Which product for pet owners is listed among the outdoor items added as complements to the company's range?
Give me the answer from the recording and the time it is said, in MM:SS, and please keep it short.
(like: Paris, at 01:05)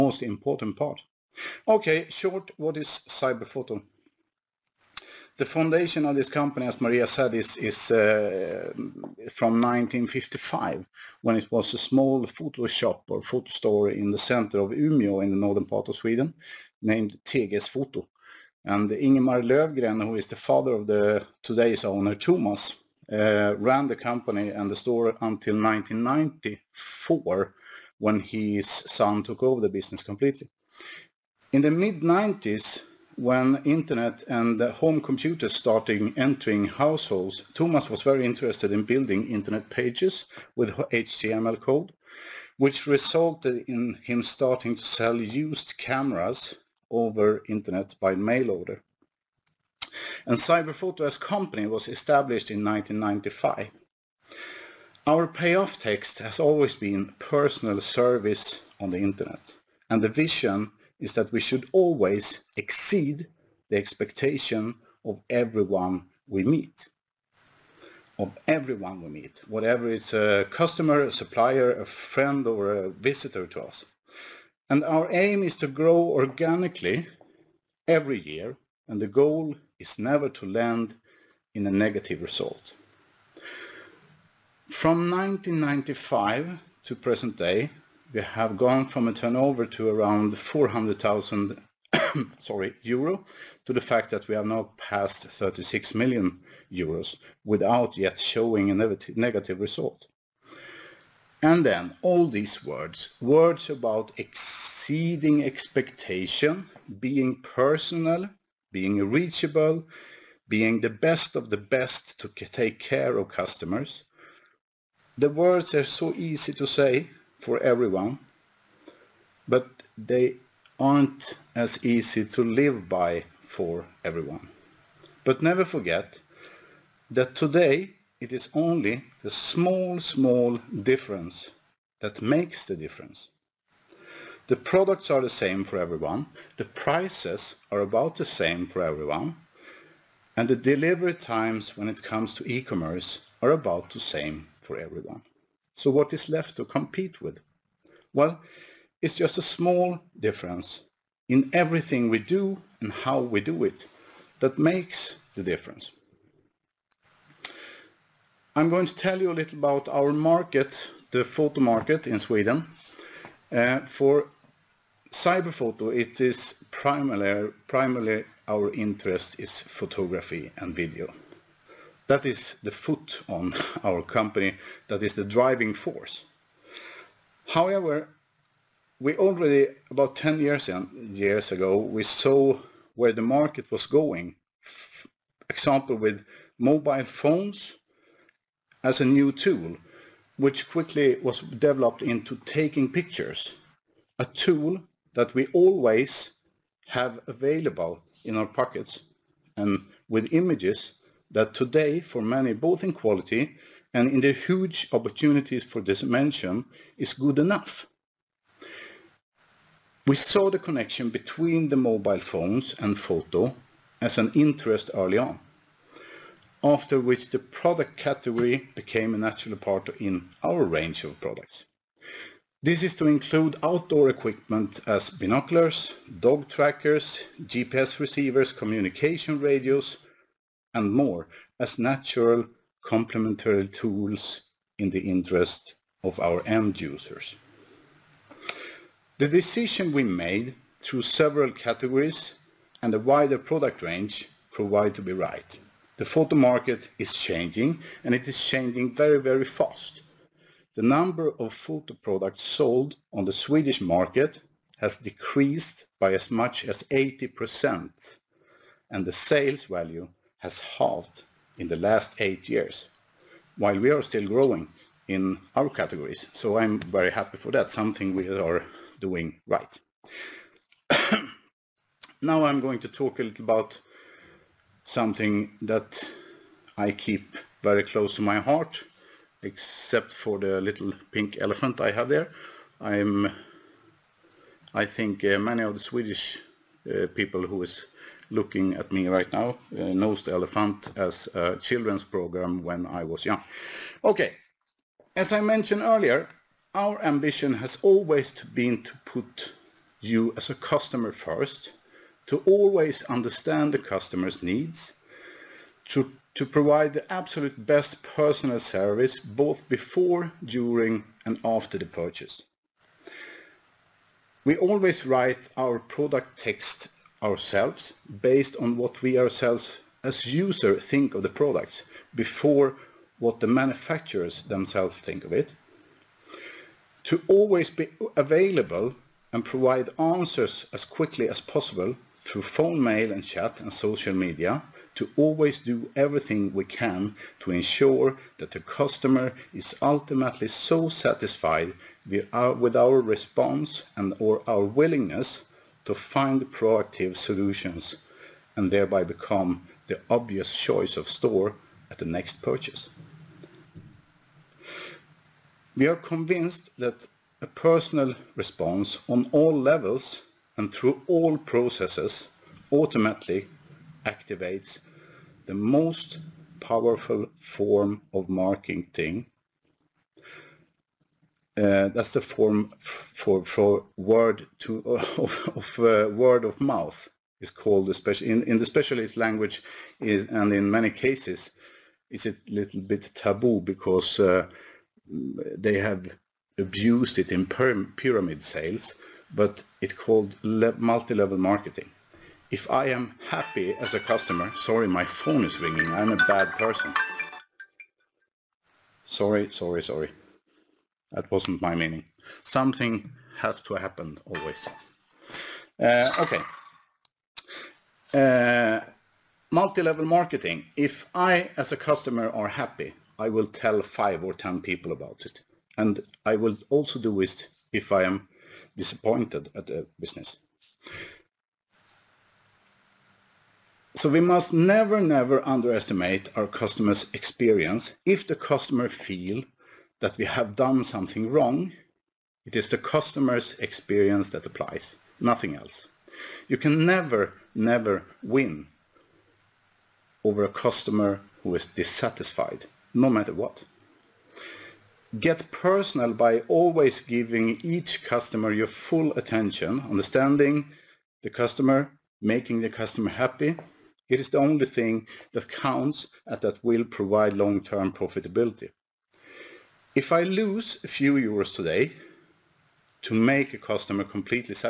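dog trackers, at 03:46.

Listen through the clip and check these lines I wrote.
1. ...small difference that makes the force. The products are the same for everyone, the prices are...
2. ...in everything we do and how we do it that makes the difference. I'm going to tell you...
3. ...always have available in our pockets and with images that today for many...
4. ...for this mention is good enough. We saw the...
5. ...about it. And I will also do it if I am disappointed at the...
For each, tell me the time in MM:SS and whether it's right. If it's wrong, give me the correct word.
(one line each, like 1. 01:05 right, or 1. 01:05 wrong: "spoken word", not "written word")
1. 02:09 wrong: "difference", not "force"
2. 02:31 right
3. 03:15 right
4. 03:25 right
5. 06:54 right.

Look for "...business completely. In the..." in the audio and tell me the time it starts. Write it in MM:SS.
00:29.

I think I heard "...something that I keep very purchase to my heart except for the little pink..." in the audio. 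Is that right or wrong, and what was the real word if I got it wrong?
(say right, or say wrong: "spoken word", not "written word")
wrong: "close", not "purchase".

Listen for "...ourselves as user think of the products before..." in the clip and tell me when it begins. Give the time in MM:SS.
05:19.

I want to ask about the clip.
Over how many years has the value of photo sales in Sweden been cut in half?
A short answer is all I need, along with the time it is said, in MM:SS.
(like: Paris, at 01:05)
8 years, at 04:22.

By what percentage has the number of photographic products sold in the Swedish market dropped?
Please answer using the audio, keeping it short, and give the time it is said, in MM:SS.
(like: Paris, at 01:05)
80%, at 04:16.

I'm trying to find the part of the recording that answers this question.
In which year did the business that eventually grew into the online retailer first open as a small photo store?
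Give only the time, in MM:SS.
00:09.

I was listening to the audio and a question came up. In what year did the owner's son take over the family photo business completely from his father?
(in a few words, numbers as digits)
1994.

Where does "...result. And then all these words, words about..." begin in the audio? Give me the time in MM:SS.
01:39.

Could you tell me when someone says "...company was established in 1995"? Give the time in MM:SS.
00:51.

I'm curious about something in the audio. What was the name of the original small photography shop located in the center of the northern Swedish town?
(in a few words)
Teges Foto.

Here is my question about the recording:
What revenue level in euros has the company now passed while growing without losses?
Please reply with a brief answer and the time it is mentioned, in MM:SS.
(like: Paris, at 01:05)
36 million euros, at 01:35.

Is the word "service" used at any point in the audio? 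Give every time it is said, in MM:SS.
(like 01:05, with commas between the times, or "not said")
00:57, 05:08.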